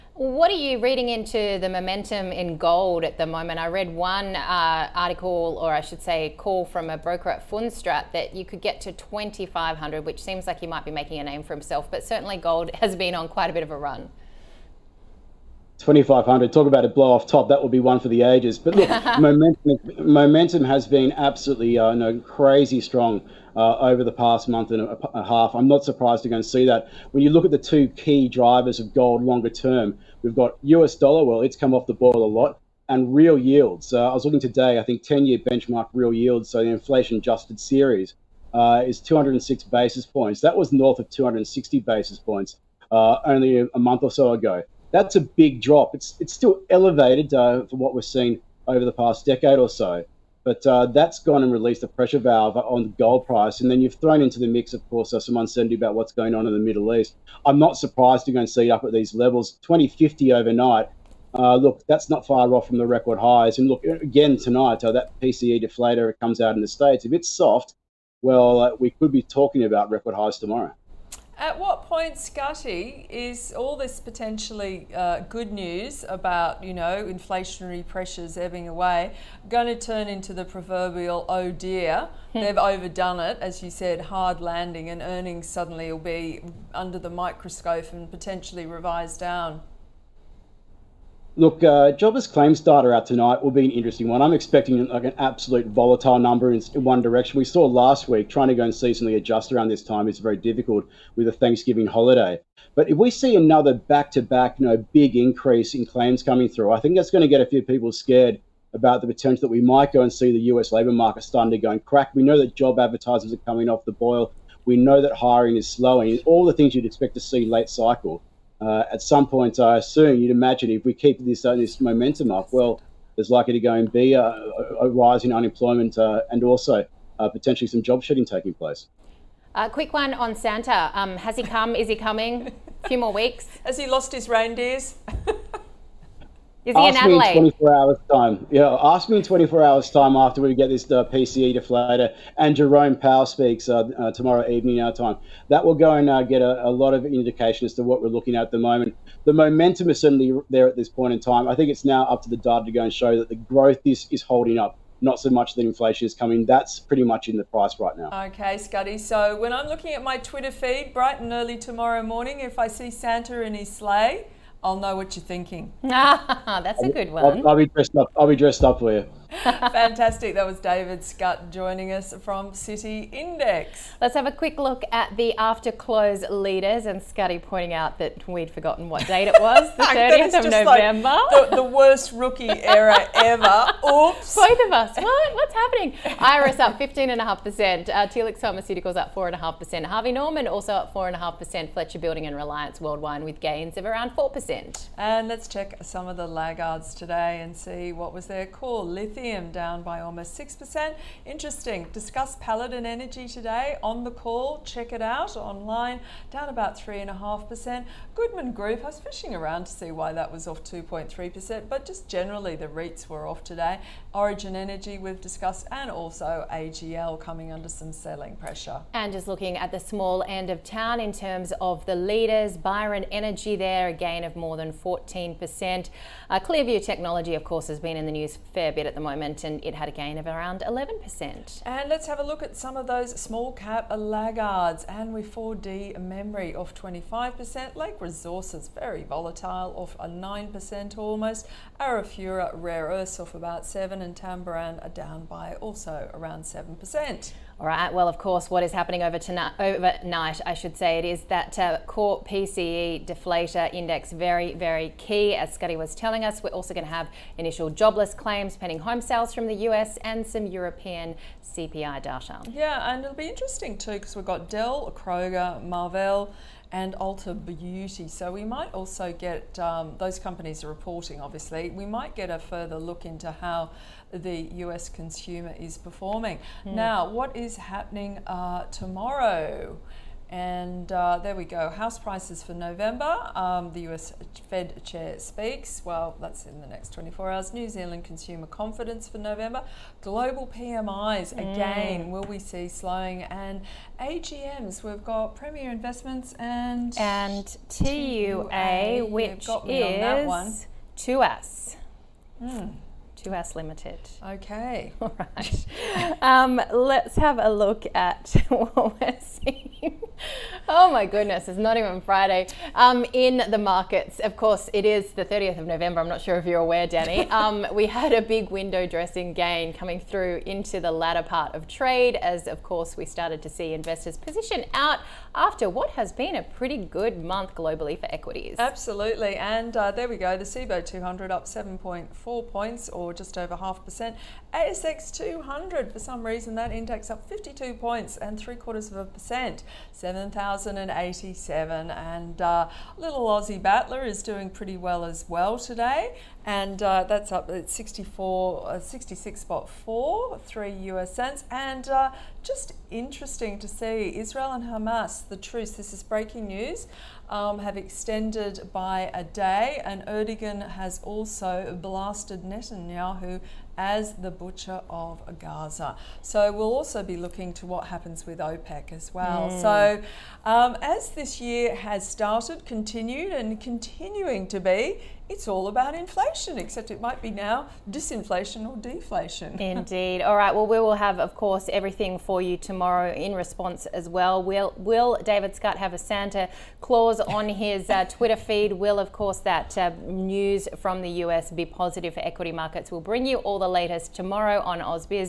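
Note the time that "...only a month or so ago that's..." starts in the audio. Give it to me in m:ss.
0:43.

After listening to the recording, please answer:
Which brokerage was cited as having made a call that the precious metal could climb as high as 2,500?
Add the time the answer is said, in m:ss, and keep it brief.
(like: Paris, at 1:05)
Fundstrat, at 0:07.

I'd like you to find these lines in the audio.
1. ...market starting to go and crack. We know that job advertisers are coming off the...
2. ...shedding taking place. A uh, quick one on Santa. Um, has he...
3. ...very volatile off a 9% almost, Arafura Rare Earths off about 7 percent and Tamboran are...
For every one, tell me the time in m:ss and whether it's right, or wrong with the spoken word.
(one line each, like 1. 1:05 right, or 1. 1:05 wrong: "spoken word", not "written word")
1. 1:50 right
2. 2:08 right
3. 3:58 right.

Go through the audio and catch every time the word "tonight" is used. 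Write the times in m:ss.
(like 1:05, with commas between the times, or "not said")
1:04, 1:33, 4:09.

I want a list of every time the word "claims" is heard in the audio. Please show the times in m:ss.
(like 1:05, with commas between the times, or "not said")
1:32, 1:45, 4:18.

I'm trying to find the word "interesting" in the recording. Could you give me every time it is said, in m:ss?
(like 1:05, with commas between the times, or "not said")
1:33, 3:21, 4:23, 5:52.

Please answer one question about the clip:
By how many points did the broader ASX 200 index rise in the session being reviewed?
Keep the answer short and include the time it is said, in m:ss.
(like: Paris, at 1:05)
52 points, at 5:37.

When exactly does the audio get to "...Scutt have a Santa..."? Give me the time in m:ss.
6:25.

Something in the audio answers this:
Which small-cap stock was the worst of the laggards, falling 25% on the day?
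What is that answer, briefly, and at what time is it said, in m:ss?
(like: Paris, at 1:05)
4D memory, at 3:55.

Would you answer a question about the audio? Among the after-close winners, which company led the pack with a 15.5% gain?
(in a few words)
Iress.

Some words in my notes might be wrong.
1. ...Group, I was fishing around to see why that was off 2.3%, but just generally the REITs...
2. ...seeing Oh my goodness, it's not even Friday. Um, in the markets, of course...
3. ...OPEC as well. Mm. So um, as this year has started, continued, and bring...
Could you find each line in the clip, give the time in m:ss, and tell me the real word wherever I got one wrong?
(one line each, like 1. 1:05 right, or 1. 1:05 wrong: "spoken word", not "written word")
1. 3:28 right
2. 5:09 right
3. 6:08 wrong: "continuing", not "bring".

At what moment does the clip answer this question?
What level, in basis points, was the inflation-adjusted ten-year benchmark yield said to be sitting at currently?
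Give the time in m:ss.
0:38.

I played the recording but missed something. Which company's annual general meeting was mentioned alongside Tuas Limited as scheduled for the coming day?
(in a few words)
Premier Investments.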